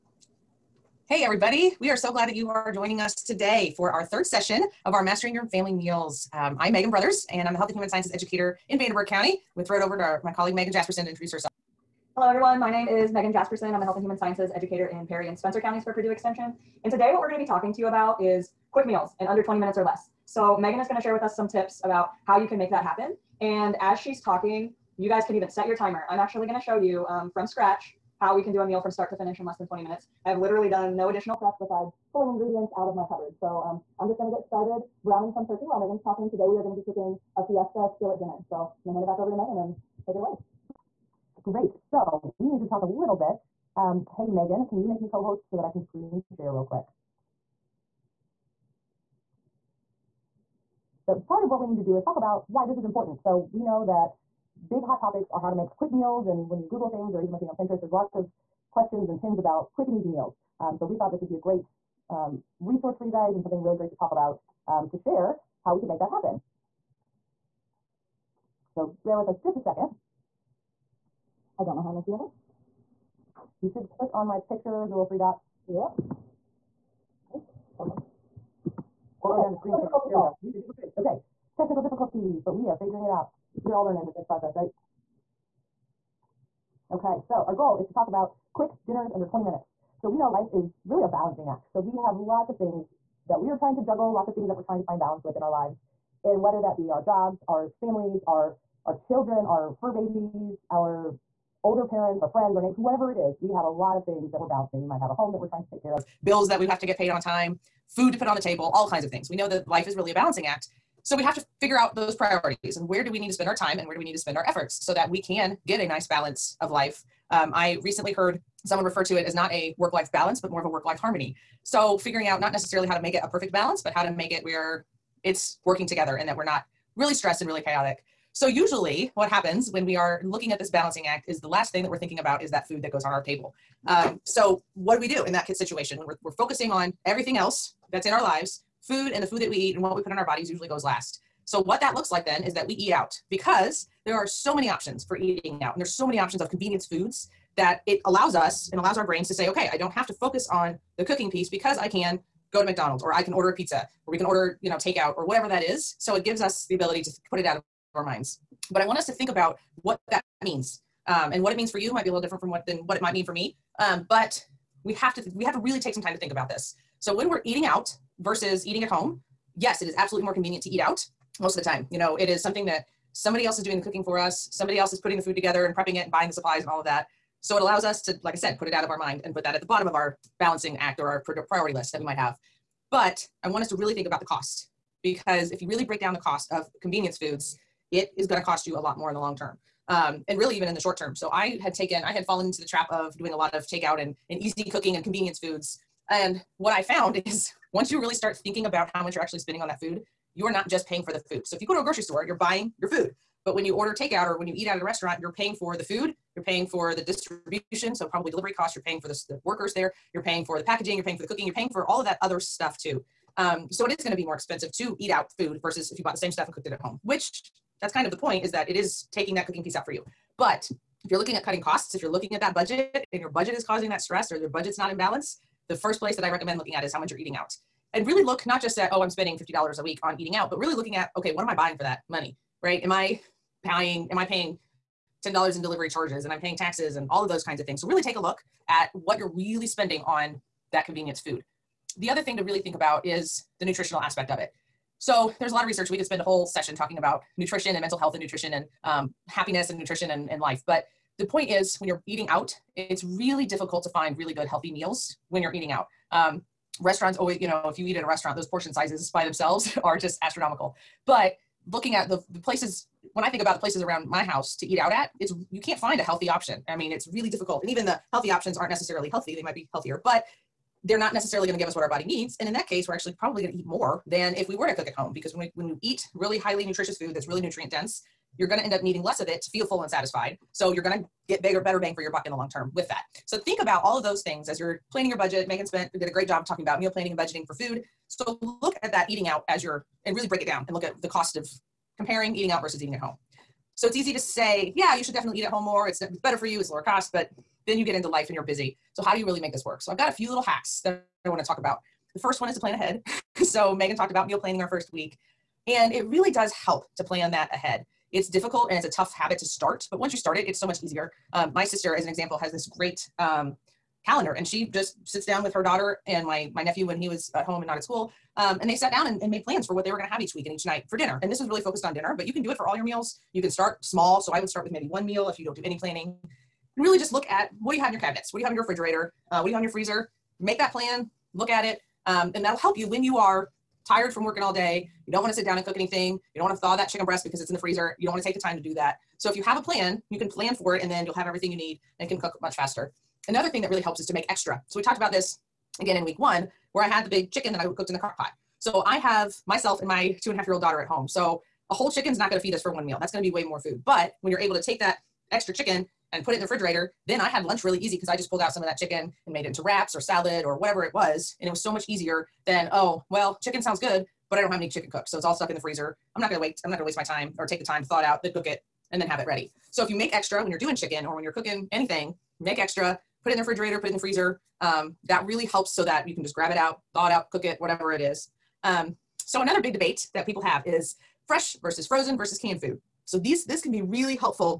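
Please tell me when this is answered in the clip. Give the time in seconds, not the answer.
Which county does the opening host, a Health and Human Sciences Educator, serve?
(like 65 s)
8 s.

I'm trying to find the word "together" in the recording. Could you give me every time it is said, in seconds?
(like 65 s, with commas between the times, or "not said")
125 s, 175 s.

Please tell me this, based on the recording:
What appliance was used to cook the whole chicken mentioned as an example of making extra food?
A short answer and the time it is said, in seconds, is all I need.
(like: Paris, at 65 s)
crock pot, at 347 s.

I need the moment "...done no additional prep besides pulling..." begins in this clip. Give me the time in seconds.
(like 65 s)
30 s.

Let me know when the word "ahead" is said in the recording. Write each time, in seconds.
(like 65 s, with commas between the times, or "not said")
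302 s, 307 s.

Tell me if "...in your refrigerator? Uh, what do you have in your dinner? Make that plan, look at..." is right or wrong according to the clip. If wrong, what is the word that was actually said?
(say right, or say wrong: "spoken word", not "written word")
wrong: "freezer", not "dinner".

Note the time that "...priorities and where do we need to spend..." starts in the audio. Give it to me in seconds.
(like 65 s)
112 s.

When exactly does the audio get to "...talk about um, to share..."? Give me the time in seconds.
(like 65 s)
63 s.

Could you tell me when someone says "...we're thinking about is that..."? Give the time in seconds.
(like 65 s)
131 s.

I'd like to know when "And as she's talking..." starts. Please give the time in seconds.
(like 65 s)
23 s.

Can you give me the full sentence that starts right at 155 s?
So it gives us the ability to put it out of our minds.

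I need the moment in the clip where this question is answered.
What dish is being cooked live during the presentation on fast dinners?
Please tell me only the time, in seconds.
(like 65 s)
37 s.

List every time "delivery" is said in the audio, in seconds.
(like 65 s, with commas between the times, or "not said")
208 s, 235 s.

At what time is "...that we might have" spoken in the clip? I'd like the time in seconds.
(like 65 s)
181 s.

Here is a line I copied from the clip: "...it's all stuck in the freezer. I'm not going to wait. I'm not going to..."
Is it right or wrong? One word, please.
right.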